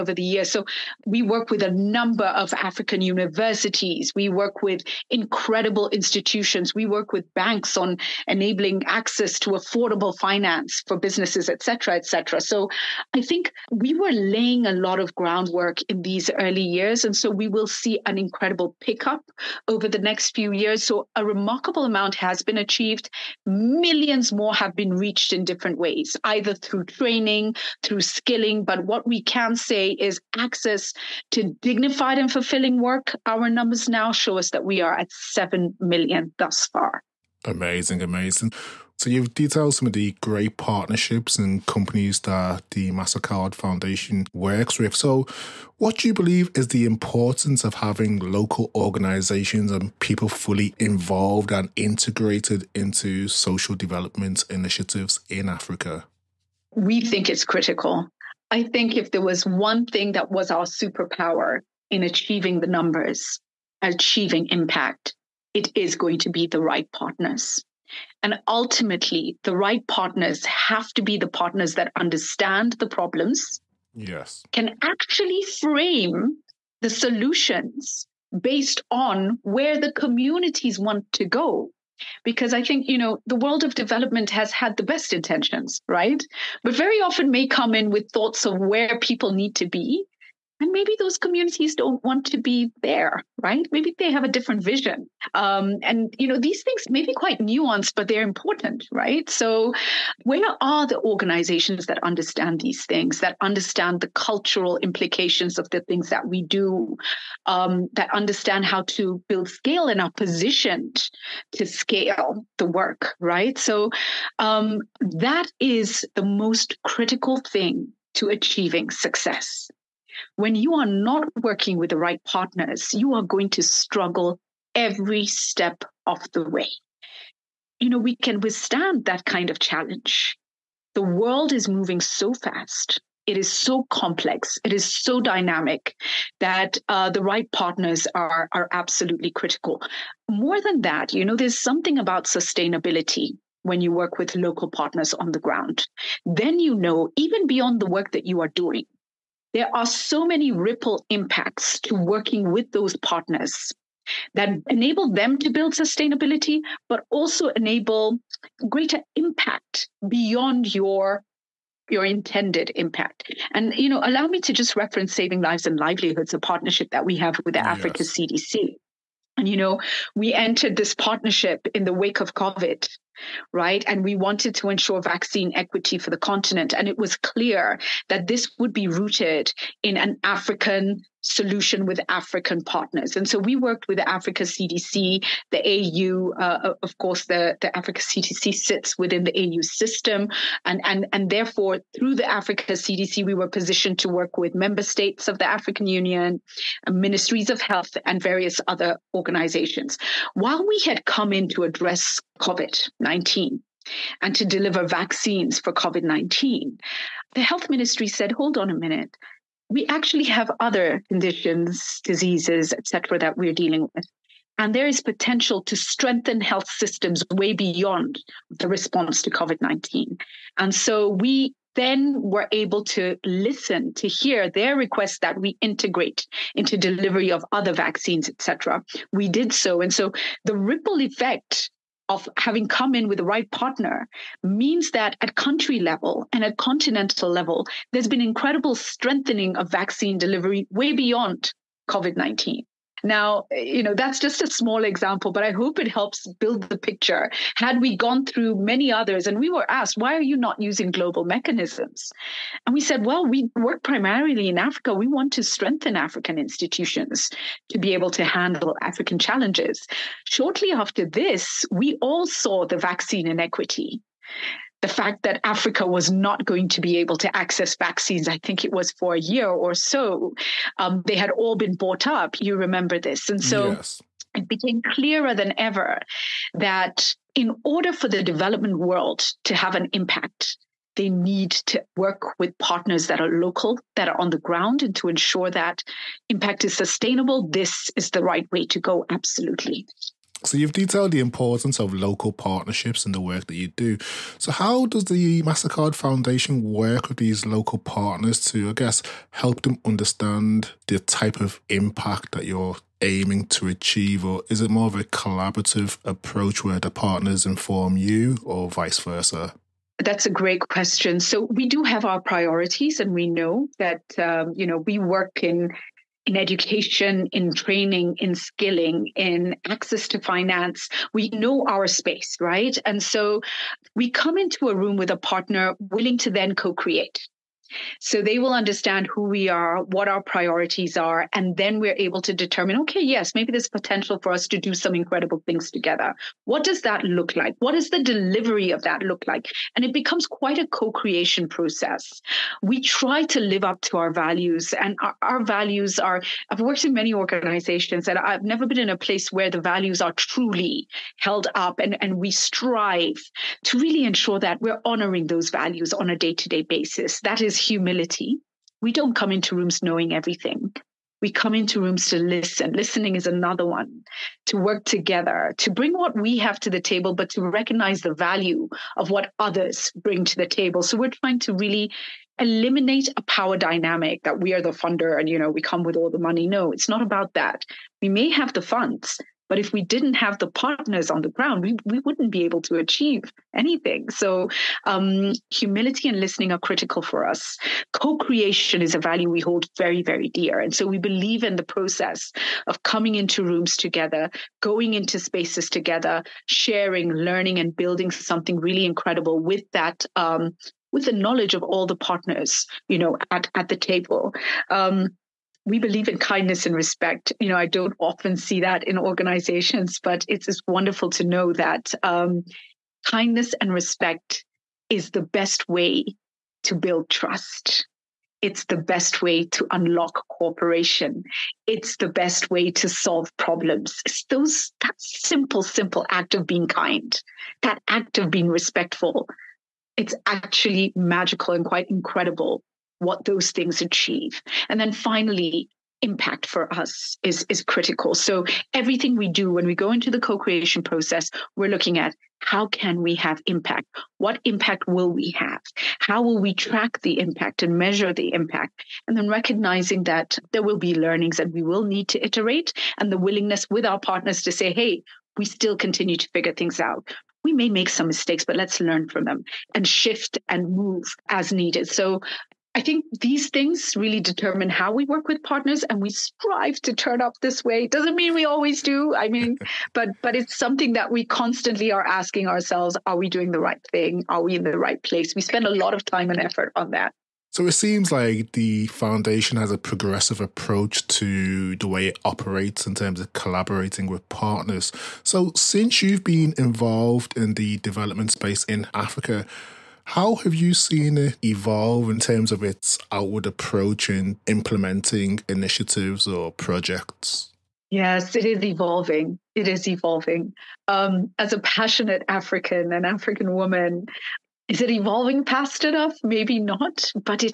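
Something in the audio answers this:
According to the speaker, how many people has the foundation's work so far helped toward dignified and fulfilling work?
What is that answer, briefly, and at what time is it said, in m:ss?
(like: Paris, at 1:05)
7 million, at 0:35.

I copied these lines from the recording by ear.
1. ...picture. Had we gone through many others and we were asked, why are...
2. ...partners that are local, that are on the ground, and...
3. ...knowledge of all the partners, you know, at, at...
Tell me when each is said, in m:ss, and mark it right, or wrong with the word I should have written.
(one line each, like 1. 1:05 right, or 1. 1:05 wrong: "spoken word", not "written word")
1. 4:06 right
2. 4:42 right
3. 6:41 right.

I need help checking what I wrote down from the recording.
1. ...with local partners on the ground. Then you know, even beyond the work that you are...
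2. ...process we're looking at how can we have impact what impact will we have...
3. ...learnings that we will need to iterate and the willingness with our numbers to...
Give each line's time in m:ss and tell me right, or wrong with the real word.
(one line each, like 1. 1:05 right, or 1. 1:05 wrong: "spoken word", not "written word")
1. 2:24 right
2. 7:20 right
3. 7:30 wrong: "partners", not "numbers".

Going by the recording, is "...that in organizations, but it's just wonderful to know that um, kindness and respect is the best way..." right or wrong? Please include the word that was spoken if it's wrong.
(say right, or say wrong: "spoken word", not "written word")
right.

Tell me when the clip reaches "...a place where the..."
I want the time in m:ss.
5:48.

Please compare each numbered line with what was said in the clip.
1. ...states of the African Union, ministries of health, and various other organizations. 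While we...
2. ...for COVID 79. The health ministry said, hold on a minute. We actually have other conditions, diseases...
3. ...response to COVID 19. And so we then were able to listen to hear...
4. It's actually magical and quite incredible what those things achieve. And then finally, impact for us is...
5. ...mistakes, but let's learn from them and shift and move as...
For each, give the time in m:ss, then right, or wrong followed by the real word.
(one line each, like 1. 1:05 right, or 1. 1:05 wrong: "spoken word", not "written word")
1. 3:14 right
2. 3:25 wrong: "19", not "79"
3. 3:38 right
4. 7:09 right
5. 7:38 right.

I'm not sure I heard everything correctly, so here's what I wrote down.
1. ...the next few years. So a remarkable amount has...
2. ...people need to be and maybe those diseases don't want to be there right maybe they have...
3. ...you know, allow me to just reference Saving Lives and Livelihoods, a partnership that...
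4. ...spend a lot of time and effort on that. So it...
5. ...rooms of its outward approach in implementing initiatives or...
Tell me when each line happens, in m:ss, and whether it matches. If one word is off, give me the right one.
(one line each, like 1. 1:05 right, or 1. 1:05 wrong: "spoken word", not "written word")
1. 0:19 right
2. 1:28 wrong: "communities", not "diseases"
3. 2:43 right
4. 7:55 right
5. 8:12 wrong: "terms", not "rooms".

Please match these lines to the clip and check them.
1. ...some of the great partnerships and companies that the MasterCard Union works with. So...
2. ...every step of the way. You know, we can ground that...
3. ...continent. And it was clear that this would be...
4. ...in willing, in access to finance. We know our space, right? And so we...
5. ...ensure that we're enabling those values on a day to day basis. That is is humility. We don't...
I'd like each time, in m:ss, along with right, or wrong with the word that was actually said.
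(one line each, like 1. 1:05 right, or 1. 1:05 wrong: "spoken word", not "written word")
1. 0:39 wrong: "Foundation", not "Union"
2. 2:04 wrong: "withstand", not "ground"
3. 2:56 right
4. 5:18 wrong: "skilling", not "willing"
5. 5:54 wrong: "honoring", not "enabling".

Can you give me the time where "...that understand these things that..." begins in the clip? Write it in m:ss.
1:41.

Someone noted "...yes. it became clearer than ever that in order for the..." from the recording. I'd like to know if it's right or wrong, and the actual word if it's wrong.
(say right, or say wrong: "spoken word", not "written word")
right.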